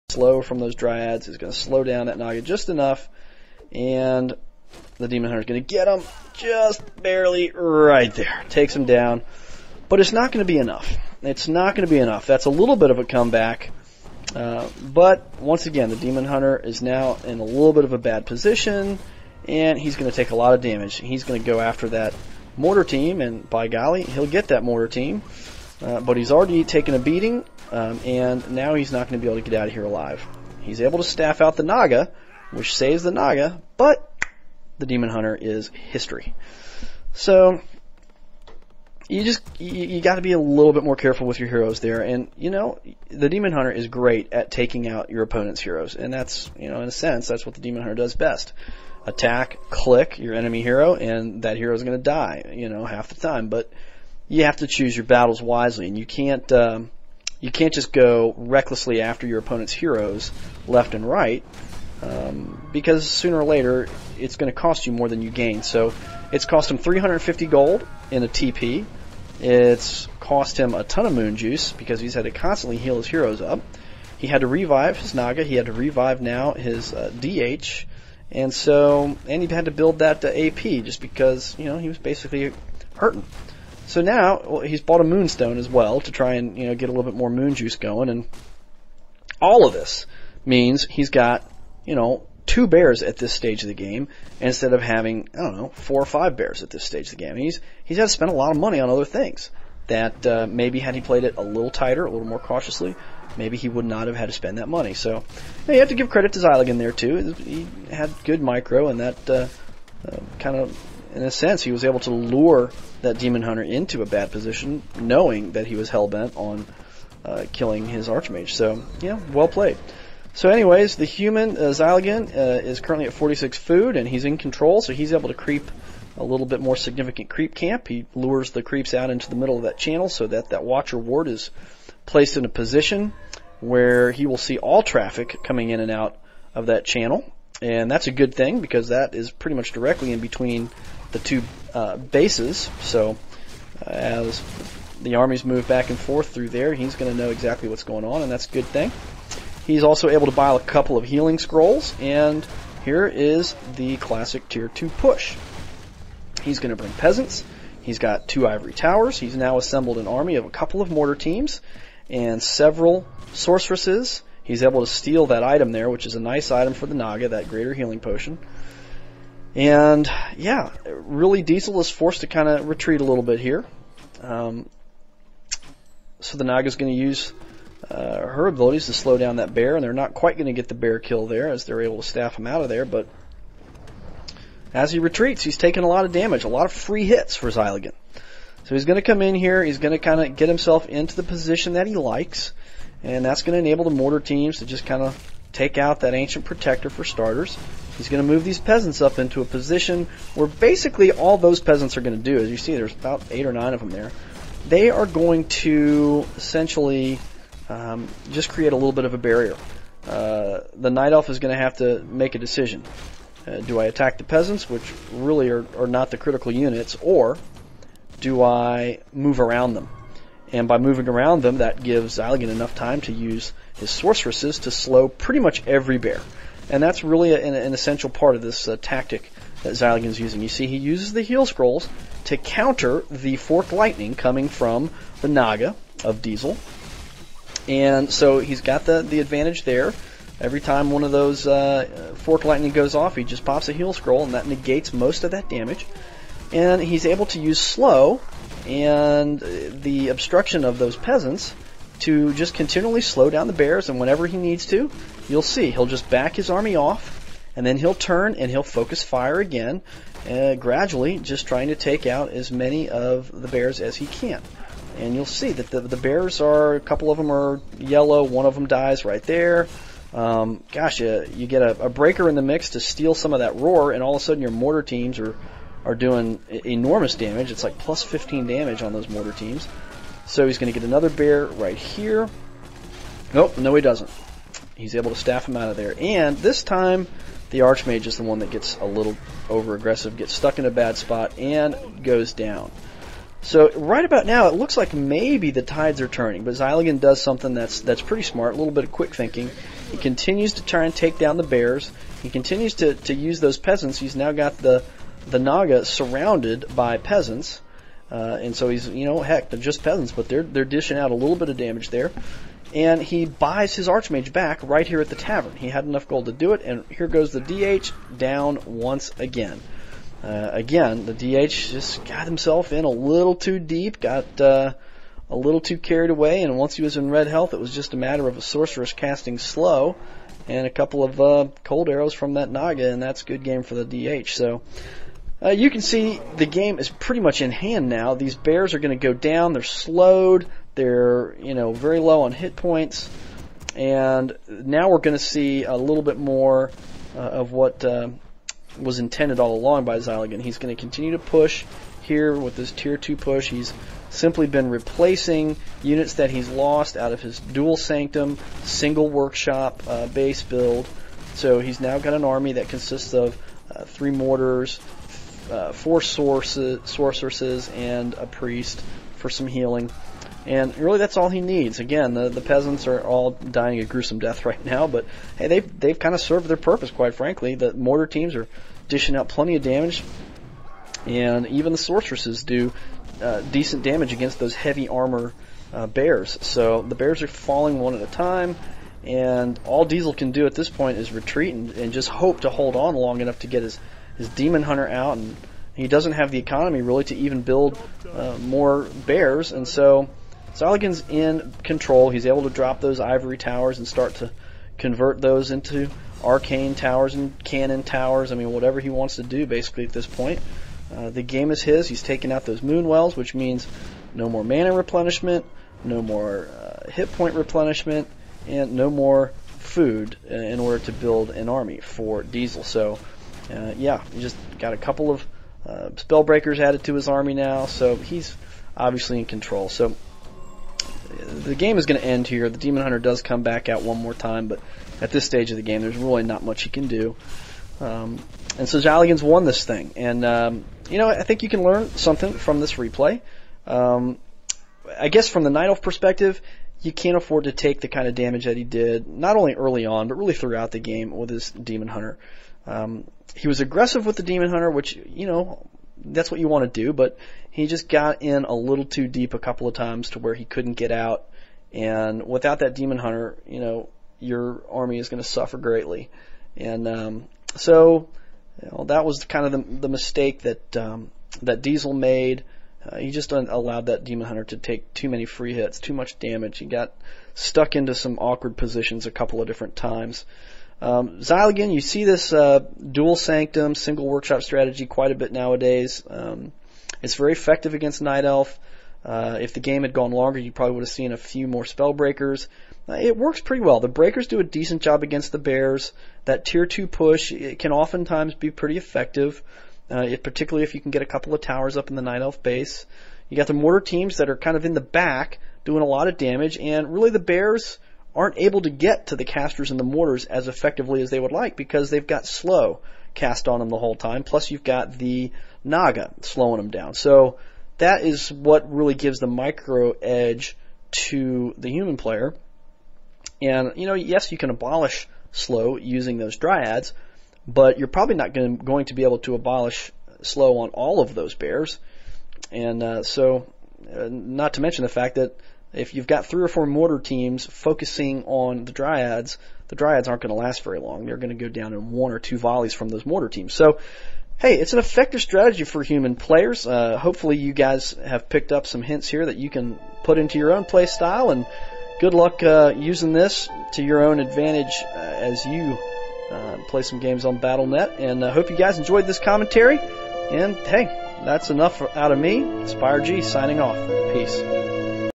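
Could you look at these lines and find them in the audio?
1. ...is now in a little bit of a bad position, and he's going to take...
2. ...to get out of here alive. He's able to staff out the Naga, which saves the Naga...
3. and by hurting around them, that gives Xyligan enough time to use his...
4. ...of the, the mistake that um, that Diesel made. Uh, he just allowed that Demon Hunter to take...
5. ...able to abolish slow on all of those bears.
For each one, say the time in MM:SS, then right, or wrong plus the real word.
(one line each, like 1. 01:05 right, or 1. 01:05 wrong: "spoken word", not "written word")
1. 00:16 right
2. 00:29 right
3. 03:40 wrong: "moving", not "hurting"
4. 07:49 right
5. 08:49 right.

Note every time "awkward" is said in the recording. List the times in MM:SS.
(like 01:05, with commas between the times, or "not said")
07:58.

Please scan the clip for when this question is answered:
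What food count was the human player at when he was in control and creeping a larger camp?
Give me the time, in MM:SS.
02:03.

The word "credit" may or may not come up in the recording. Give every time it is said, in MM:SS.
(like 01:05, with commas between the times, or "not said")
01:46.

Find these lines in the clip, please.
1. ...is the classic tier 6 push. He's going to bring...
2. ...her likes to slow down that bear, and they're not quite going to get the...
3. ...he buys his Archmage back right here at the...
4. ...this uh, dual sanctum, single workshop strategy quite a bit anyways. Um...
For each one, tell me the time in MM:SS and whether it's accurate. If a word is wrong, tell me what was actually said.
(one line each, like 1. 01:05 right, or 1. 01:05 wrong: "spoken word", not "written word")
1. 02:33 wrong: "2", not "6"
2. 02:58 wrong: "abilities", not "likes"
3. 05:13 right
4. 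08:02 wrong: "nowadays", not "anyways".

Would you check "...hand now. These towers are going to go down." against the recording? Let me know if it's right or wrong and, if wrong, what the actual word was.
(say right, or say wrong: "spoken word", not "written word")
wrong: "bears", not "towers".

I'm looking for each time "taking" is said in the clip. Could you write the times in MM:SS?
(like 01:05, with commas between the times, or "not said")
00:44, 03:05.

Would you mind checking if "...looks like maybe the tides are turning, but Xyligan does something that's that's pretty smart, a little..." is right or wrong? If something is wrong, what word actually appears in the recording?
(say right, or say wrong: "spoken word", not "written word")
right.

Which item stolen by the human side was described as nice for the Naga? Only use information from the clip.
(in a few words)
greater healing potion.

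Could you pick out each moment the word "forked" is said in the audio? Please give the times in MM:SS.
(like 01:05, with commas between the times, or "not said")
03:53, 04:02.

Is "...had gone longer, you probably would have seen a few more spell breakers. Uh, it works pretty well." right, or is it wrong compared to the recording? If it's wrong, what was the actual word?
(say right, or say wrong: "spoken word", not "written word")
right.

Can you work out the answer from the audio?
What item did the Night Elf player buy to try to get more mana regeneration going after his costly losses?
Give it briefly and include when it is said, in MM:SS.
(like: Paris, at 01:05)
moonstone, at 01:25.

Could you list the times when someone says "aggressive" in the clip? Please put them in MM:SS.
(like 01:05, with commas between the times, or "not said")
04:49, 07:33.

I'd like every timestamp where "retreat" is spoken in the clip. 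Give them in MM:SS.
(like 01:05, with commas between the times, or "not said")
02:52, 03:04, 06:31.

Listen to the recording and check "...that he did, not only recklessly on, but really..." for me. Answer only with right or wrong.
wrong.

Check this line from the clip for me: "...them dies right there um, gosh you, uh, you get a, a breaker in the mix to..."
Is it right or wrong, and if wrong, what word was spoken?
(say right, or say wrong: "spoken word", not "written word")
right.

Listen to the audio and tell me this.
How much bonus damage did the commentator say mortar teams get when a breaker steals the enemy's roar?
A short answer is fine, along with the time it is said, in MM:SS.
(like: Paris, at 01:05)
plus 15, at 04:37.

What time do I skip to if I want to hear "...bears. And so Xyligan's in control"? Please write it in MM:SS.
06:39.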